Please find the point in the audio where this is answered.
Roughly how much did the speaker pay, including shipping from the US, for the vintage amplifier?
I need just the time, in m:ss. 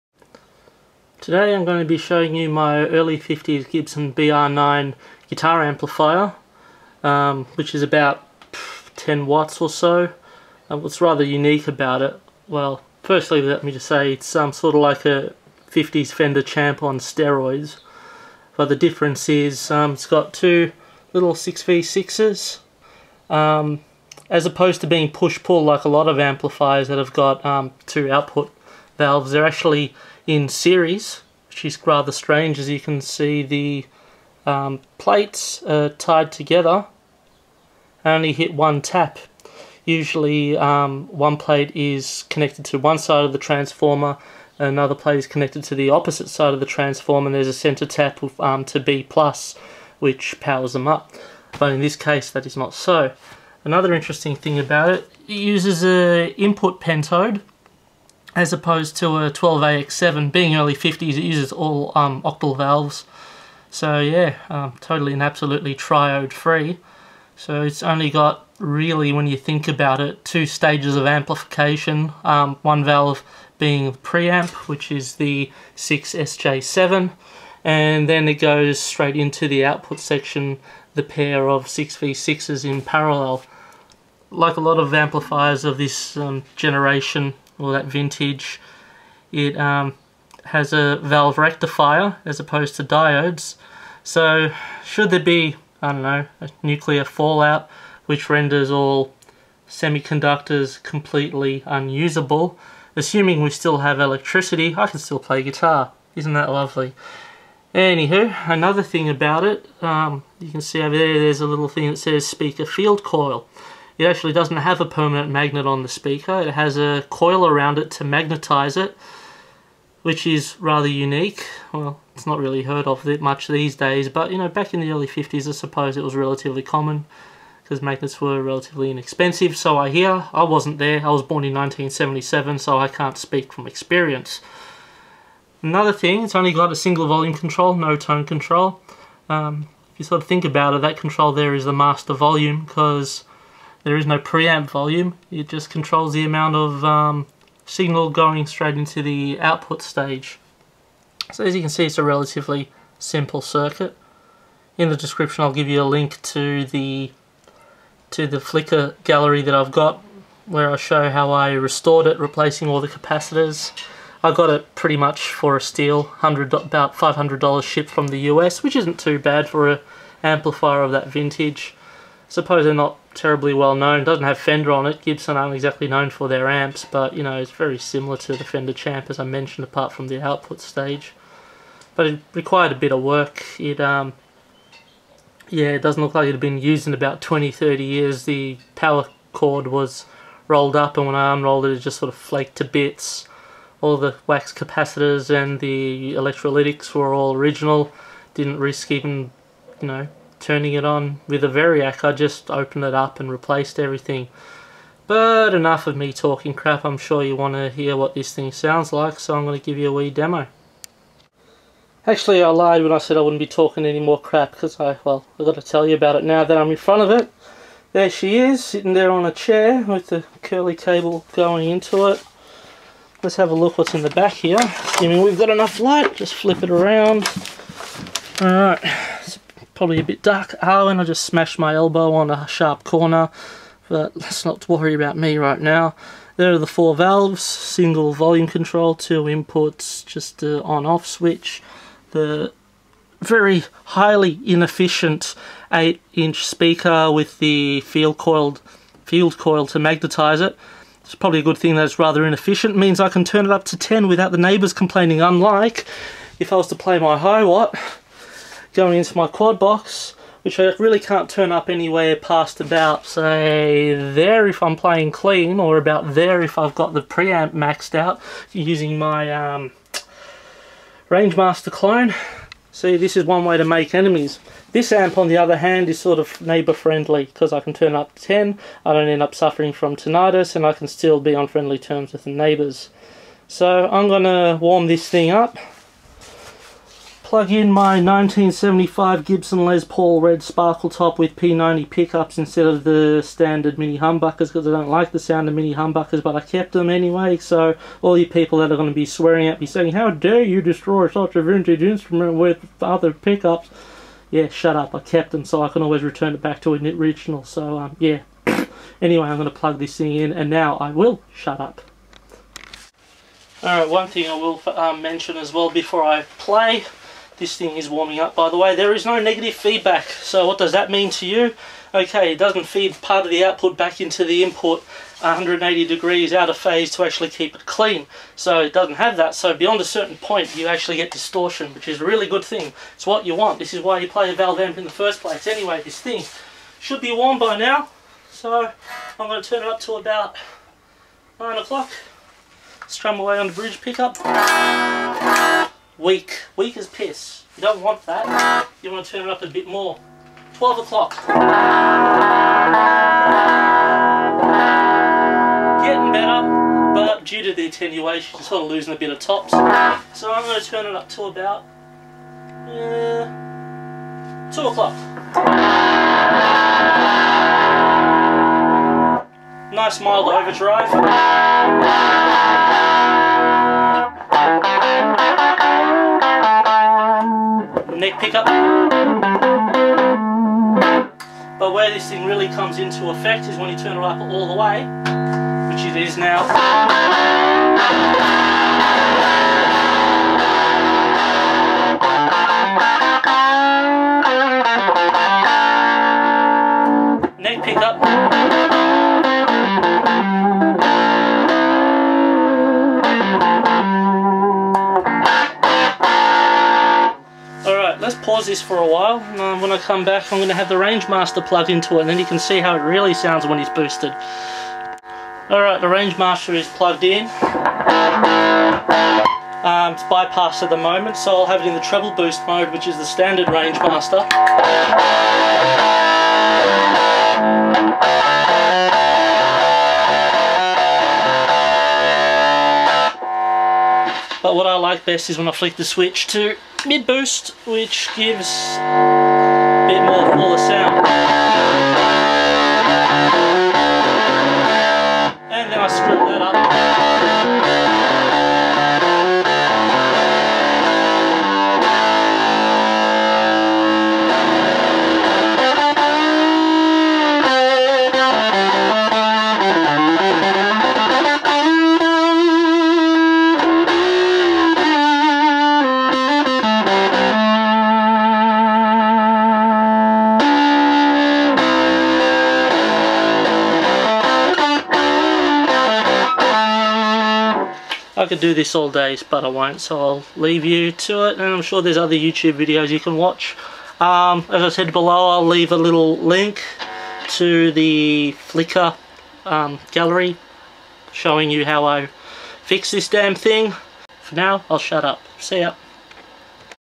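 2:46.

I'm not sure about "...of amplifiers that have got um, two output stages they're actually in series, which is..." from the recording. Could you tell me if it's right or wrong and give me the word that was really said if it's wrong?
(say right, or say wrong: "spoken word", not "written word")
wrong: "valves", not "stages".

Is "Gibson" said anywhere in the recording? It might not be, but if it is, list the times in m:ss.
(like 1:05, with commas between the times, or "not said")
0:03, 2:55, 4:49.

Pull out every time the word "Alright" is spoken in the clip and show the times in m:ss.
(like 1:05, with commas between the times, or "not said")
3:48, 5:13, 6:55.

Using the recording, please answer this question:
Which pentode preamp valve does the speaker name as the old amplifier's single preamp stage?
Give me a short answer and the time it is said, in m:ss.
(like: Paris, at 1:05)
6SJ7, at 1:15.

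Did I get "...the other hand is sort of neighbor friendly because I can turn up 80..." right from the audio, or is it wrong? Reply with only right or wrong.
wrong.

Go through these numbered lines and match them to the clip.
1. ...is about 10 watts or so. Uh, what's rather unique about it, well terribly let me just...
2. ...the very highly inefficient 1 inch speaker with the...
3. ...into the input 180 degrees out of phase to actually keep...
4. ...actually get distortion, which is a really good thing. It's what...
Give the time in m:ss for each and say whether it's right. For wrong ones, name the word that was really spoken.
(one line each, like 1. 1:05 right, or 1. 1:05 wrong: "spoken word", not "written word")
1. 0:07 wrong: "firstly", not "terribly"
2. 4:02 wrong: "8", not "1"
3. 5:23 right
4. 5:30 right.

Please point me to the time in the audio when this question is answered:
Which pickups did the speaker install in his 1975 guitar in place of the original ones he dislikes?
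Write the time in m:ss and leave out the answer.
4:51.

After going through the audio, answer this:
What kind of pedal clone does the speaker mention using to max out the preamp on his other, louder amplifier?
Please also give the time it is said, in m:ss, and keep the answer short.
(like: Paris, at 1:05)
Rangemaster clone, at 4:31.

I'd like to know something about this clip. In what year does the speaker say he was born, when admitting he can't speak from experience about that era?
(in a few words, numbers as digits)
1977.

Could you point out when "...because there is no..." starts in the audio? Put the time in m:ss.
2:22.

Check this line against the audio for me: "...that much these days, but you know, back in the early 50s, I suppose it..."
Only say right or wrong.
right.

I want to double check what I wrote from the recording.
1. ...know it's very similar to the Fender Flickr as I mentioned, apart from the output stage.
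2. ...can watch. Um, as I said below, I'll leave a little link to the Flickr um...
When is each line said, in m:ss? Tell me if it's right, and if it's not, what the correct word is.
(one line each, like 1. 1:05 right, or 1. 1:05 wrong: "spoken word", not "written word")
1. 2:57 wrong: "Champ", not "Flickr"
2. 8:02 right.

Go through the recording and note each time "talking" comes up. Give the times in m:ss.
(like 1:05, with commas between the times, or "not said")
3:26, 3:33.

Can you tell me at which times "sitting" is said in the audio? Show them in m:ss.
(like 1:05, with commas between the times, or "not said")
3:38.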